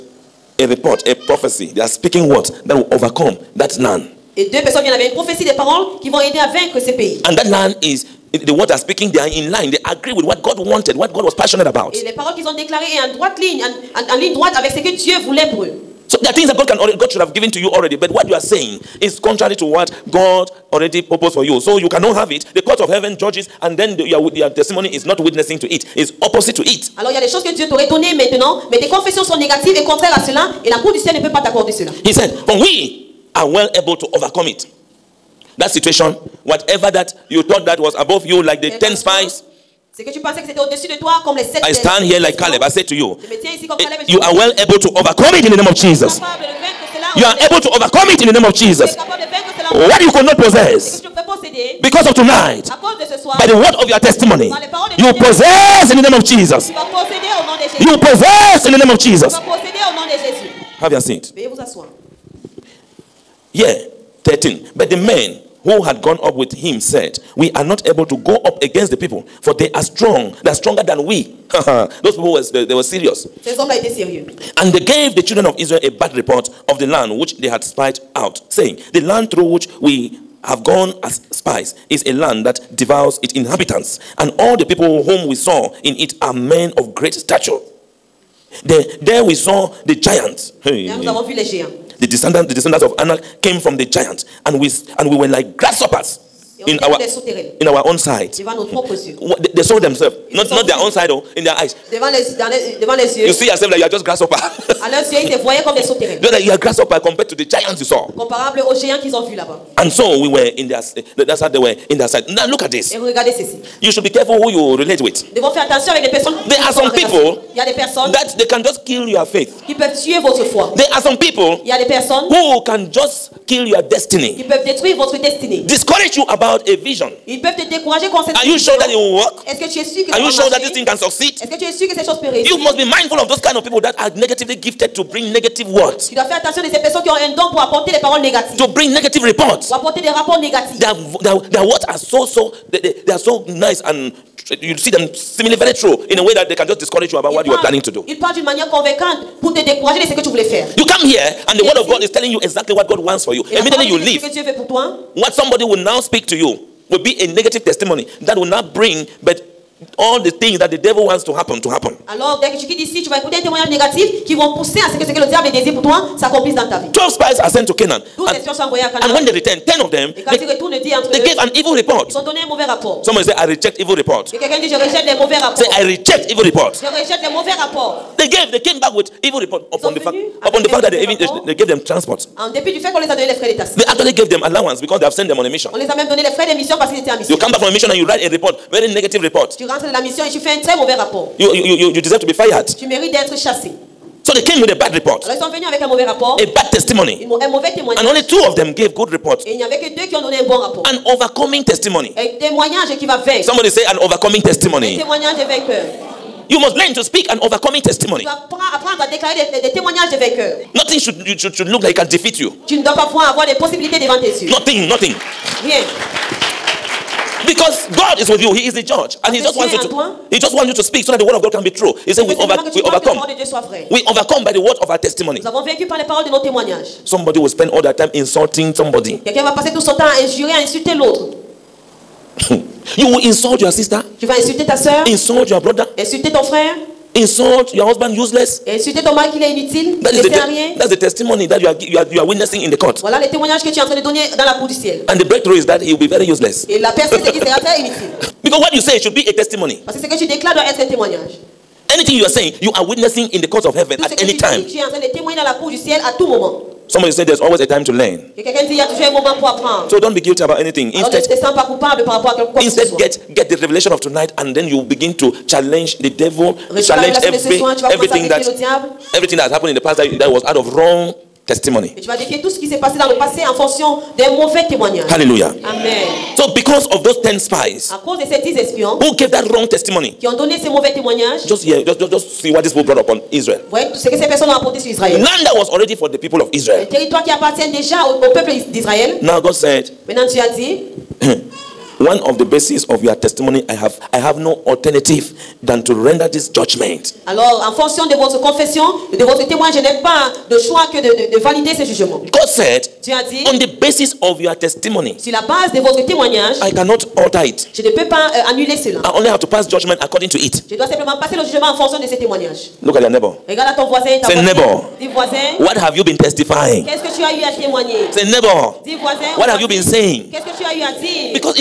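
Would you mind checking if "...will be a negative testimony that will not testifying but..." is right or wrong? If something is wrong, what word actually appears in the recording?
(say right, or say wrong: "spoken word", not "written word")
wrong: "bring", not "testifying".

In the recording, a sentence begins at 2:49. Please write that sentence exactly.
And when they return, 10 of them, they, ils gave an evil report.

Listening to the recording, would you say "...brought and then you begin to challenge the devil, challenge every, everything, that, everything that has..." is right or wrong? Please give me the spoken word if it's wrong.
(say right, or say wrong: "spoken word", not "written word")
wrong: "tonight", not "brought".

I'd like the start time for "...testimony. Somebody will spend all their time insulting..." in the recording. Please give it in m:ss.
3:44.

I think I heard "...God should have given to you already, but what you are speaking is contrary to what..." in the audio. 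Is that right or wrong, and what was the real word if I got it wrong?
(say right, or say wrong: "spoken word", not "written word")
wrong: "saying", not "speaking".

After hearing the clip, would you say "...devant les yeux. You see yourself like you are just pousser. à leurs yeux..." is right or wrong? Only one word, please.
wrong.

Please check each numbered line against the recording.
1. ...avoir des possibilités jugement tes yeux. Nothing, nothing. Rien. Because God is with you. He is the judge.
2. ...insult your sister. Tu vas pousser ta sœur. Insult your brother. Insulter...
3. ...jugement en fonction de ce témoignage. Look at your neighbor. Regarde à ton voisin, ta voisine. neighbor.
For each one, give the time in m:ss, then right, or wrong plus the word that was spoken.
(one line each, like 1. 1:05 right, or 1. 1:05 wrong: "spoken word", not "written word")
1. 3:33 wrong: "devant", not "jugement"
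2. 3:53 wrong: "insulter", not "pousser"
3. 5:11 right.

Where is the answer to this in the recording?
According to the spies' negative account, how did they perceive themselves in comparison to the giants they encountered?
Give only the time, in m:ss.
1:35.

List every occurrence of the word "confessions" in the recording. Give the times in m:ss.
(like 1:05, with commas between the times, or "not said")
0:28, 4:58.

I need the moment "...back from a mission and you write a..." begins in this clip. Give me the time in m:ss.
3:07.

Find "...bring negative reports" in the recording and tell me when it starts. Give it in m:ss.
2:18.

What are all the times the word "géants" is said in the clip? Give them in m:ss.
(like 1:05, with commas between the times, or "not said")
1:31, 1:48.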